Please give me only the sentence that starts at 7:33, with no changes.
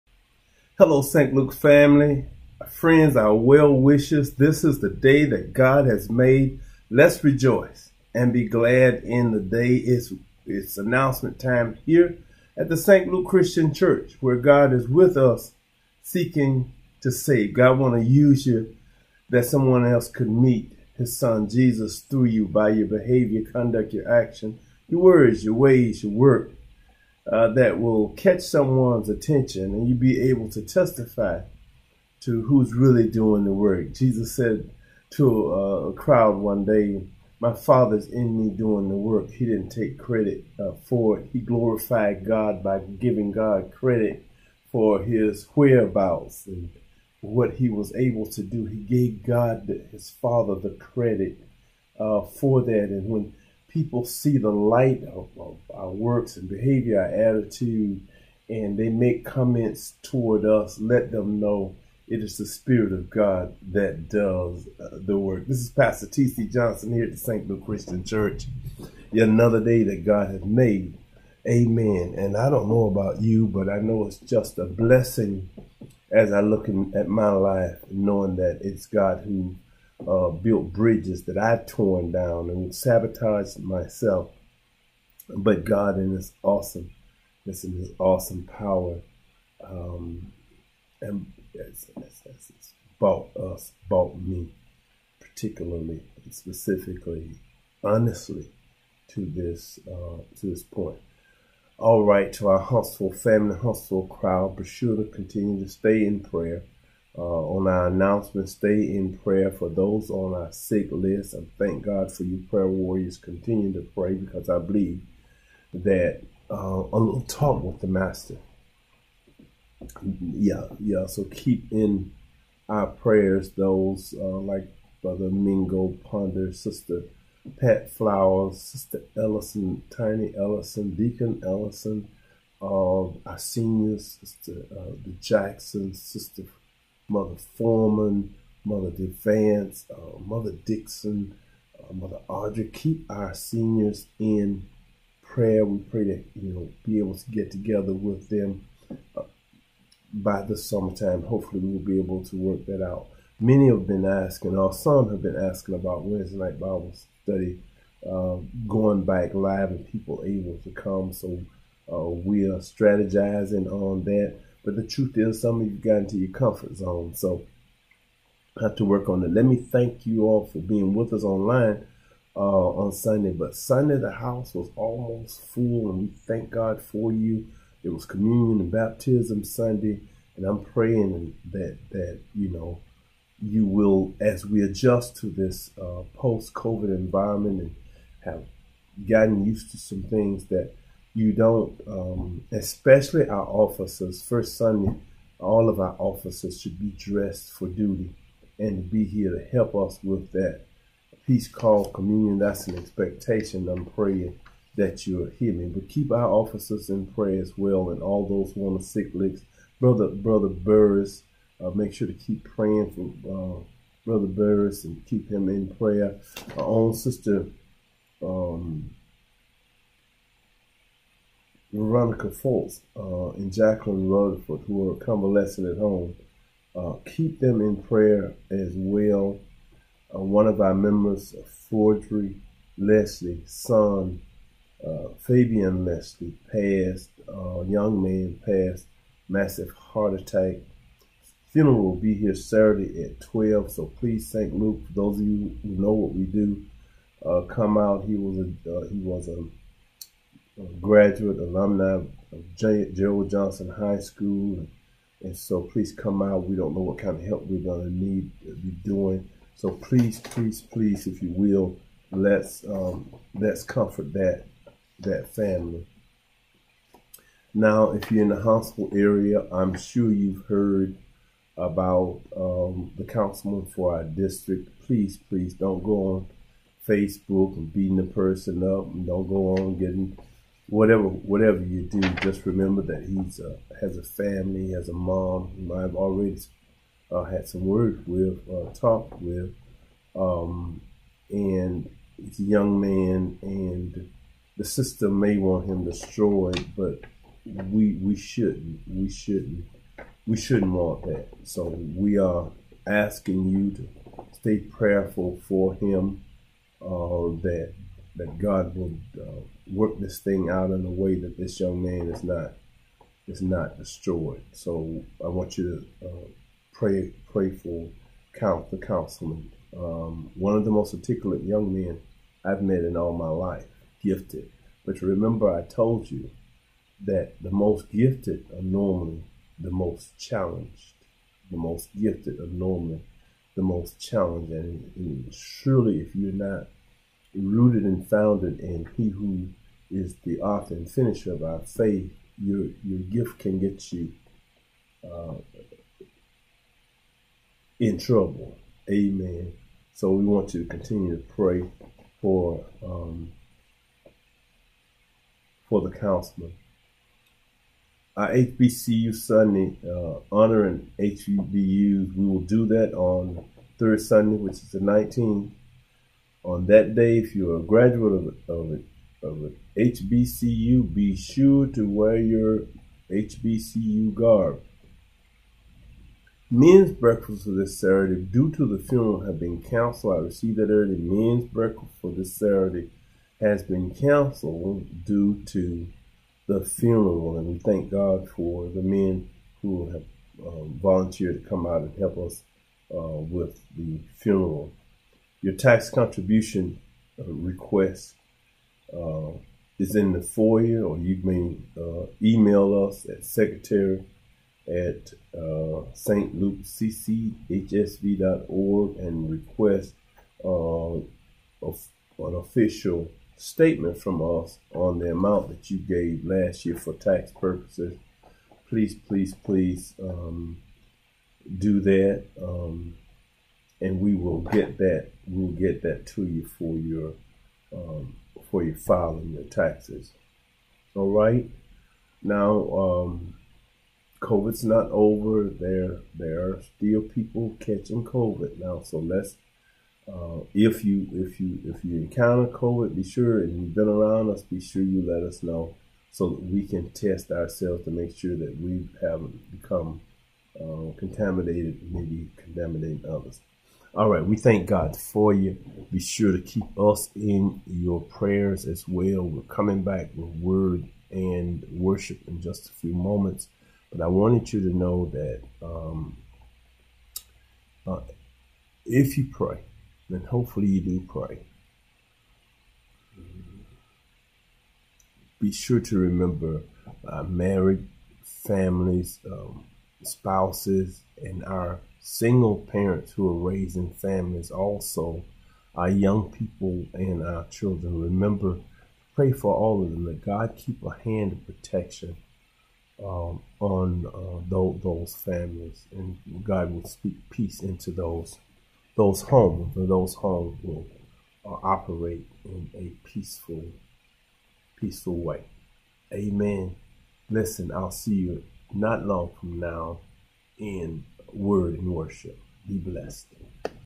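All right, we thank God for you.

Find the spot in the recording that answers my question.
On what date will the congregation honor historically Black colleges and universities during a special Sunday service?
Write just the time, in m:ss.
6:04.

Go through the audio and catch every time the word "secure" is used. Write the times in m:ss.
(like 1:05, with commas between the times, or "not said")
not said.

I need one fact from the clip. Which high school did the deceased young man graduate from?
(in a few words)
J- Gerald Johnson High School.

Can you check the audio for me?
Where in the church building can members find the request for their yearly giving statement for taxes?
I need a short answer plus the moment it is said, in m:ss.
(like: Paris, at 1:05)
the foyer, at 6:40.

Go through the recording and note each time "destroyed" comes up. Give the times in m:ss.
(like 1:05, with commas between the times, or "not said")
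4:55, 5:13.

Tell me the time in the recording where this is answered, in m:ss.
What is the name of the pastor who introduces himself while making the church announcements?
1:06.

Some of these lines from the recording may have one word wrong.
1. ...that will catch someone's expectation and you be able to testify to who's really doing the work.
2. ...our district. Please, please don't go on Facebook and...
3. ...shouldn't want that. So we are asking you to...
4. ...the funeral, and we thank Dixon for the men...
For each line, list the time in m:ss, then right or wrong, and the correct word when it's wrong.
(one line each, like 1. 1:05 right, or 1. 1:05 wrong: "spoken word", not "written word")
1. 0:27 wrong: "attention", not "expectation"
2. 4:33 right
3. 5:00 right
4. 6:26 wrong: "God", not "Dixon".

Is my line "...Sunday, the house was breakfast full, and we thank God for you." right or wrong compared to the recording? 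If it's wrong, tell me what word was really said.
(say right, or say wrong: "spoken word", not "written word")
wrong: "almost", not "breakfast".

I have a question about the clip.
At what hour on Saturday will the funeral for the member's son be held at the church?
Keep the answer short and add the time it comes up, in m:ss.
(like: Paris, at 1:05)
12, at 4:03.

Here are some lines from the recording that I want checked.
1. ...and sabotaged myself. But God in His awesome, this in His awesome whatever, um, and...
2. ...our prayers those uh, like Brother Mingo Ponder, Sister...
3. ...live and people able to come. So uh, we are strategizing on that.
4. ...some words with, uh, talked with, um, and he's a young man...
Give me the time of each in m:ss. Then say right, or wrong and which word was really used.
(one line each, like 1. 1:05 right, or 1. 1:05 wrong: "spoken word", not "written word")
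1. 1:22 wrong: "power", not "whatever"
2. 2:02 right
3. 2:39 right
4. 4:47 right.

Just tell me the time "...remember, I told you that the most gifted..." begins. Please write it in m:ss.
5:25.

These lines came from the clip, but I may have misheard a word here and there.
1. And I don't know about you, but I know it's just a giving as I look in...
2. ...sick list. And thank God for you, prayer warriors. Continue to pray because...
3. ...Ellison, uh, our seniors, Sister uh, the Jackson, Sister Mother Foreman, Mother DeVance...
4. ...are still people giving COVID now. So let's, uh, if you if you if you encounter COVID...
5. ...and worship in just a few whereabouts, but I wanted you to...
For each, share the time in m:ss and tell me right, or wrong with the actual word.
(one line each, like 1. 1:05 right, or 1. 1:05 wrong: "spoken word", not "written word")
1. 1:12 wrong: "blessing", not "giving"
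2. 1:50 right
3. 2:11 right
4. 7:16 wrong: "catching", not "giving"
5. 7:41 wrong: "moments", not "whereabouts".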